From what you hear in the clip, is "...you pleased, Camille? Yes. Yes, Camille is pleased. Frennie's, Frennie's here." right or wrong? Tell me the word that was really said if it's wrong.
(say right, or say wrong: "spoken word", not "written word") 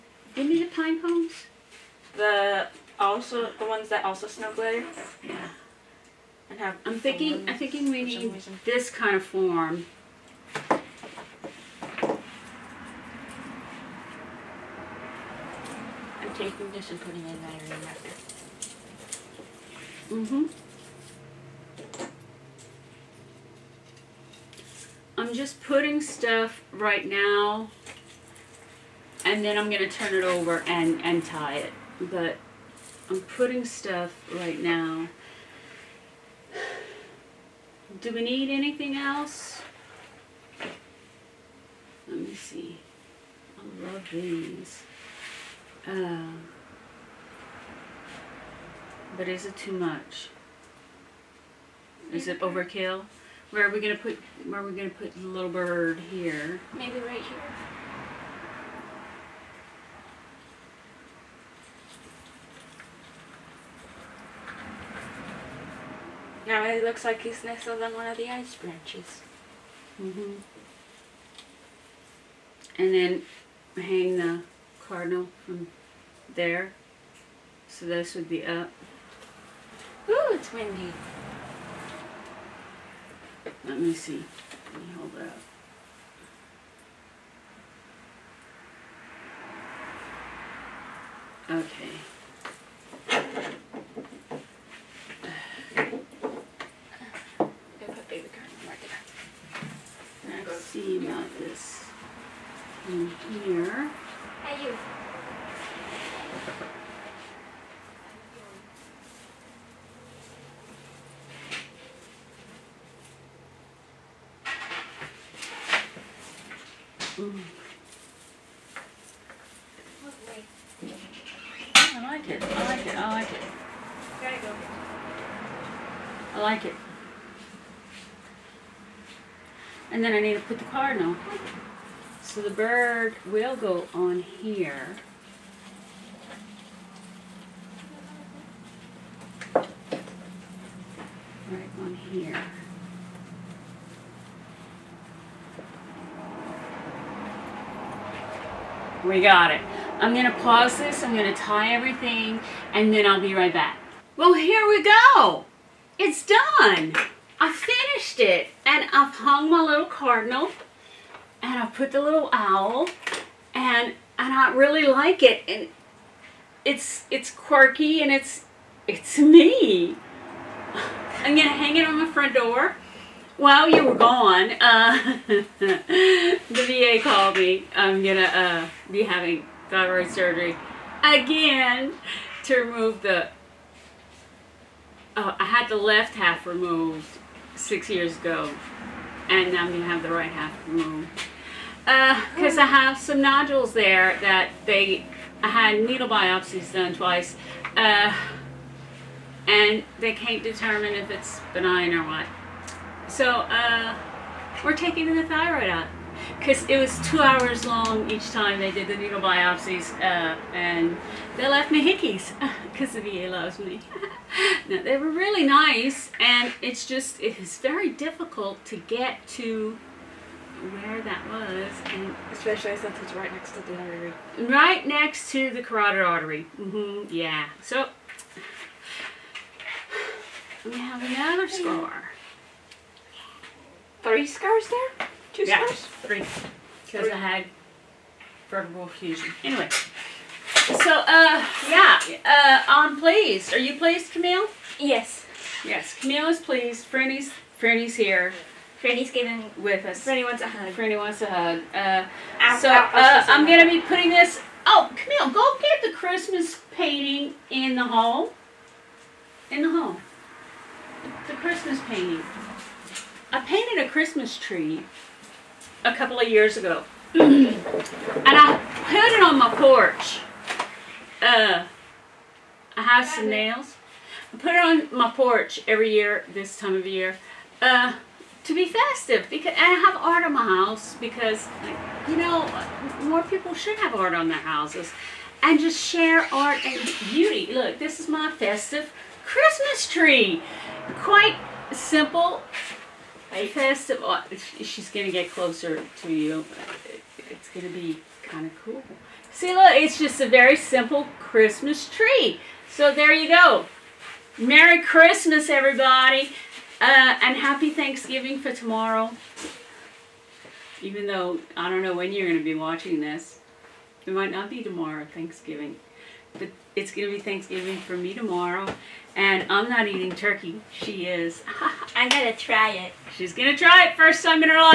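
right.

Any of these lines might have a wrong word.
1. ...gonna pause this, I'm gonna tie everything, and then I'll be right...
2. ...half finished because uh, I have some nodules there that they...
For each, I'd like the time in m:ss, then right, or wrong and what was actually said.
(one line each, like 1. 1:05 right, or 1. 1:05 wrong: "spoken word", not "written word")
1. 2:30 right
2. 3:10 wrong: "removed", not "finished".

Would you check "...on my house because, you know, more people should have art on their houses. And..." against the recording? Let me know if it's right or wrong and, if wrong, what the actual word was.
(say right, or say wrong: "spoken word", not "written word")
right.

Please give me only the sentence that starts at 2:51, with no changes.
I'm gonna hang it on my front door.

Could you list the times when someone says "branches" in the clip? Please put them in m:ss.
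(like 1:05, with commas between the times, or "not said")
1:08.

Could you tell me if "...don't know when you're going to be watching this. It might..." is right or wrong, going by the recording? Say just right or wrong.
right.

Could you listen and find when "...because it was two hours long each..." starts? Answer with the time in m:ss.
3:26.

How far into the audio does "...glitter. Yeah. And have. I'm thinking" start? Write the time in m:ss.
0:04.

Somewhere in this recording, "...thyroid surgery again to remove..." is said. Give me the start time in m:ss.
2:59.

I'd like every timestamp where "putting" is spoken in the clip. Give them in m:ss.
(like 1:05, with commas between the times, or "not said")
0:17, 0:25, 0:33, 4:13.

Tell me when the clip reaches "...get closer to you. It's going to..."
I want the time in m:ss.
4:55.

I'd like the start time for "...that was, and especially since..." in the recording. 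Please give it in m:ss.
3:41.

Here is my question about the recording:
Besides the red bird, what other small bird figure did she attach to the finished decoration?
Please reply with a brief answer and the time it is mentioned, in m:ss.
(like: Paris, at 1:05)
owl, at 2:42.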